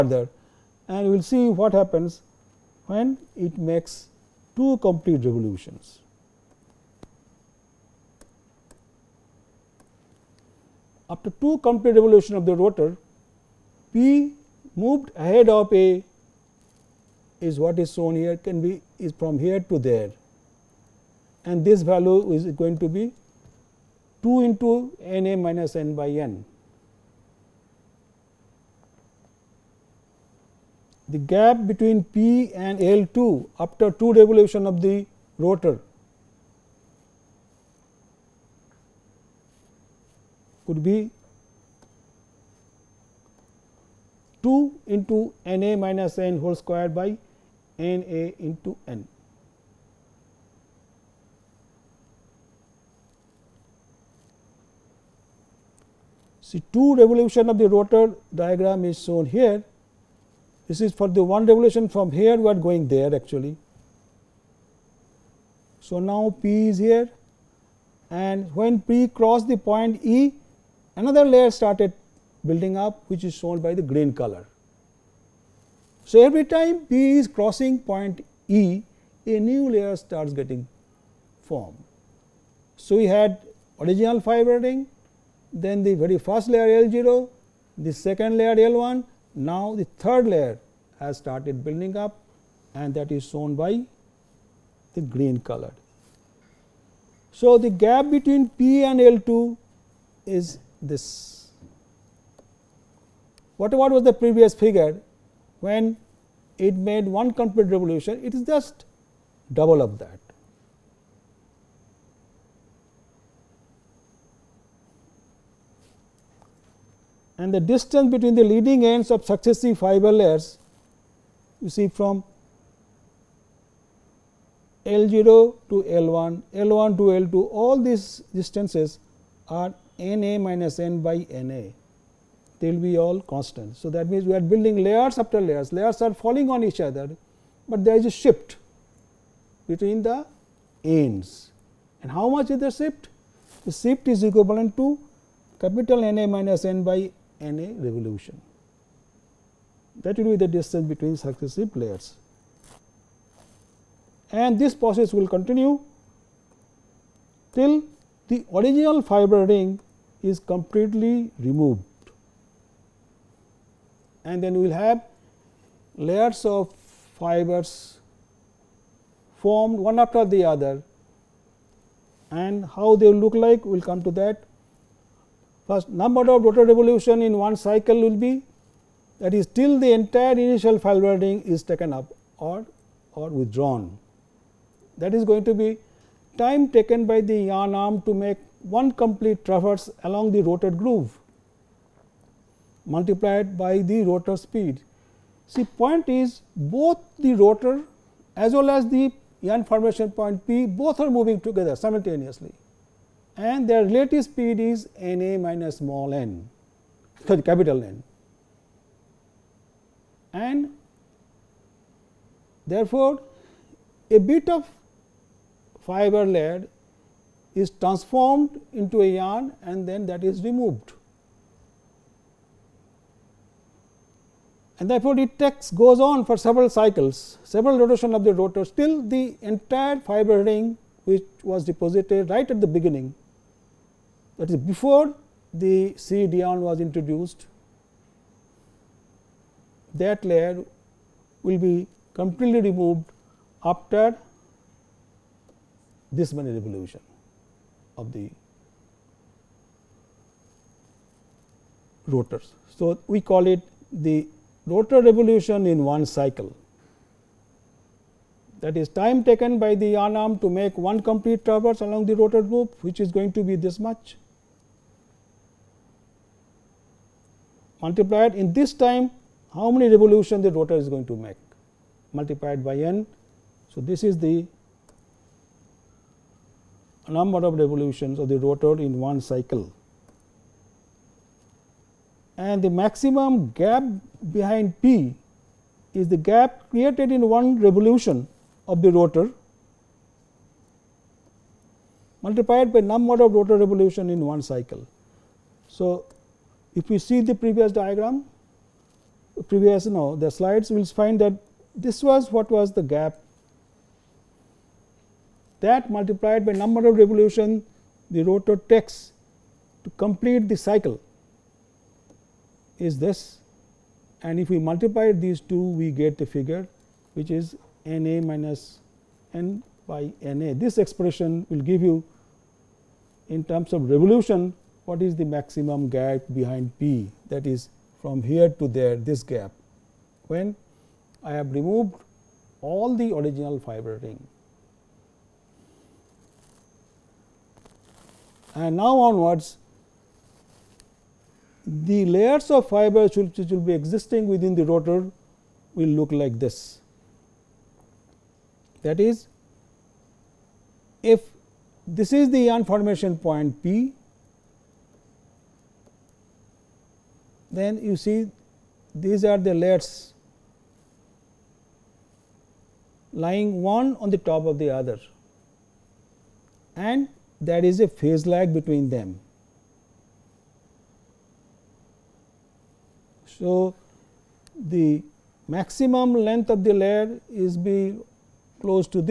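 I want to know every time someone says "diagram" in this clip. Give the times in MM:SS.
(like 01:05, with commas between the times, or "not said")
00:58, 04:57.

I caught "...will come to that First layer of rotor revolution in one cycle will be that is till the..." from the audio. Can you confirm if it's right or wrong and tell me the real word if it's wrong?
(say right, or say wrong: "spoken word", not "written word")
wrong: "number", not "layer".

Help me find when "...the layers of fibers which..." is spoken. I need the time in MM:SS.
05:41.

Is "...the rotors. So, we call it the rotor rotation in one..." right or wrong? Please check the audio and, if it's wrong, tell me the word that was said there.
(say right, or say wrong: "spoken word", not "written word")
wrong: "revolution", not "rotation".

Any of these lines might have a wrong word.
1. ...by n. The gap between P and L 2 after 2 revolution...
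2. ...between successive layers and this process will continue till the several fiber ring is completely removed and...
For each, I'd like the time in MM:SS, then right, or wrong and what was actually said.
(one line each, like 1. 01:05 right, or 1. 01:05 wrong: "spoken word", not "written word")
1. 00:25 right
2. 02:30 wrong: "original", not "several".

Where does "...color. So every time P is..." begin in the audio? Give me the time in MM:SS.
01:14.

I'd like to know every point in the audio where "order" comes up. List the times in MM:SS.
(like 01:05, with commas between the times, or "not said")
not said.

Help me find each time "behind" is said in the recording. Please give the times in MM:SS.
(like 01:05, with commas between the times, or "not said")
04:44, 05:26.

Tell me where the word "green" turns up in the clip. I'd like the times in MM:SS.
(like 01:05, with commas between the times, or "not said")
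01:13, 01:35.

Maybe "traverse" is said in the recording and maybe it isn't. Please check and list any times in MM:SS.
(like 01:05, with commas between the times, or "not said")
03:09, 04:21.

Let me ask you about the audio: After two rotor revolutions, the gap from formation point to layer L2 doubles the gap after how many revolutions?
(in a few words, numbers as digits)
1.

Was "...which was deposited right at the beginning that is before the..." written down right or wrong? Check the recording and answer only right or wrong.
right.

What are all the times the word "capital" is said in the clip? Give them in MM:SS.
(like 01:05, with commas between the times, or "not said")
02:25, 03:27.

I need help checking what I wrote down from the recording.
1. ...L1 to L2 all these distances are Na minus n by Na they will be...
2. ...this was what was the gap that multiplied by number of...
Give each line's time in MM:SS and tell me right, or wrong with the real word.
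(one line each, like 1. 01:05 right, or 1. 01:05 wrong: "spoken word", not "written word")
1. 02:06 right
2. 05:01 right.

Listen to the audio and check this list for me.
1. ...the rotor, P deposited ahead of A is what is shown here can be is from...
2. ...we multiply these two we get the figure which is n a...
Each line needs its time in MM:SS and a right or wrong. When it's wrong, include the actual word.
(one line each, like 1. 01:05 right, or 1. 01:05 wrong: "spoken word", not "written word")
1. 00:12 wrong: "moved", not "deposited"
2. 05:14 right.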